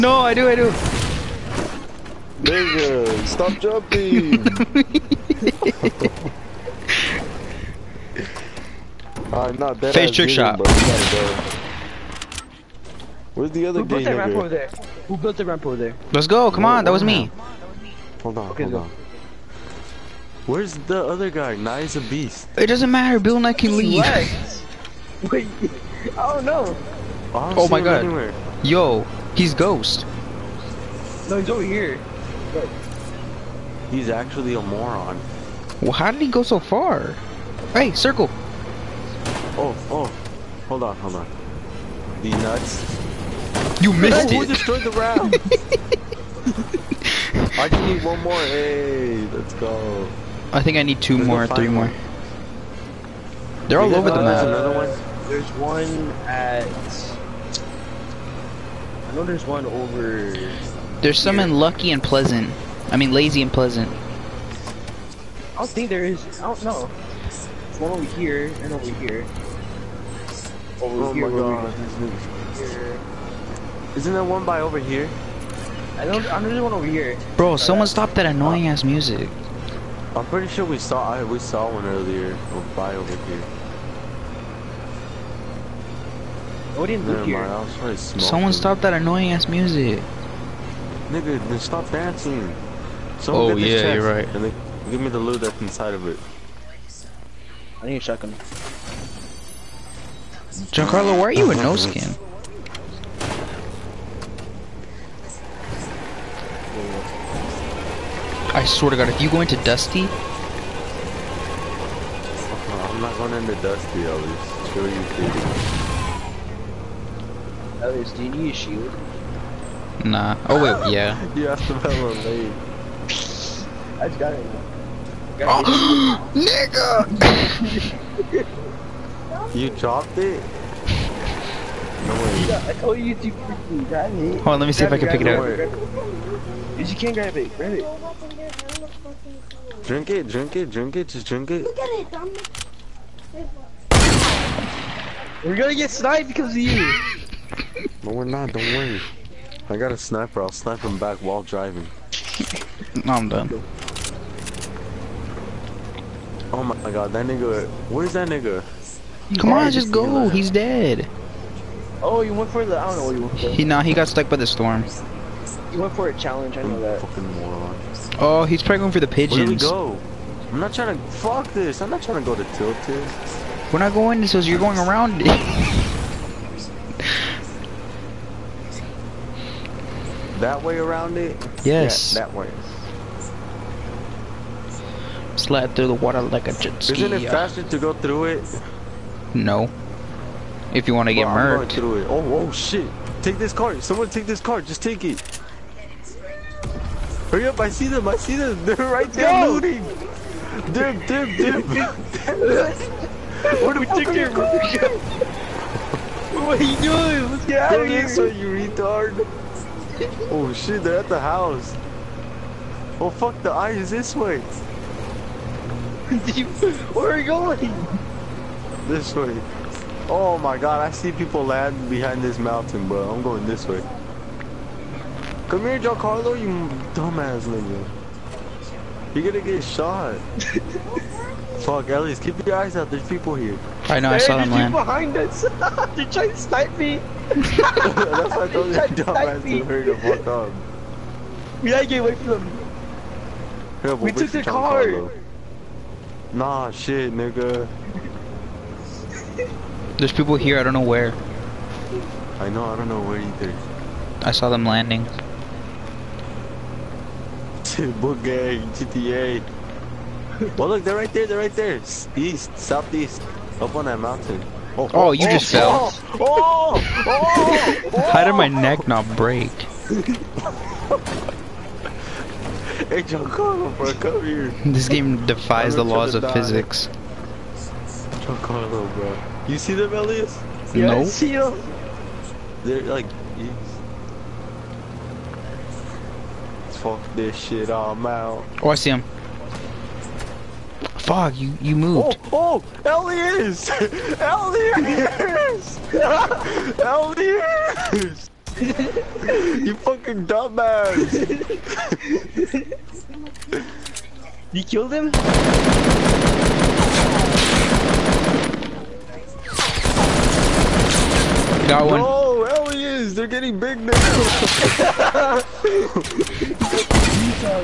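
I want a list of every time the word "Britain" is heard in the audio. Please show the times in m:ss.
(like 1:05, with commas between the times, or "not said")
not said.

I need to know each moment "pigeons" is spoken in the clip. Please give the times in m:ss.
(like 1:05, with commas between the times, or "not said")
2:49.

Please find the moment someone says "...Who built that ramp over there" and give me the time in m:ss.
0:13.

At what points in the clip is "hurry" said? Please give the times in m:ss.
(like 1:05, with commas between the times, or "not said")
3:17, 3:59.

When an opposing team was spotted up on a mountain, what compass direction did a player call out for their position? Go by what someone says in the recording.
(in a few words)
East, southeast.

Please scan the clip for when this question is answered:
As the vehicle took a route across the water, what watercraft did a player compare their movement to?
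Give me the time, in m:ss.
3:06.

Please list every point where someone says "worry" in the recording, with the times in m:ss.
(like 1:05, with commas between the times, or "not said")
2:28.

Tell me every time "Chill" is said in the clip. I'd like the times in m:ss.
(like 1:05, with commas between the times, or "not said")
1:54.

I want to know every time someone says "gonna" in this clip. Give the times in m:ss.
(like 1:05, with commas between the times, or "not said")
2:25, 3:49.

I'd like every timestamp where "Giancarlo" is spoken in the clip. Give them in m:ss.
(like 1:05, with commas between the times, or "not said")
1:40, 3:45, 4:33, 4:38.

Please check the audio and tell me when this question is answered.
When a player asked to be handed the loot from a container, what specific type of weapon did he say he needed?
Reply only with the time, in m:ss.
1:37.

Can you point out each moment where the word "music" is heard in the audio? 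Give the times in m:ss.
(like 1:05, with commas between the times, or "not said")
1:18, 1:29.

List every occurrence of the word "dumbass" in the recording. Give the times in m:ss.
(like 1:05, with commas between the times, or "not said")
3:46, 3:58, 5:00.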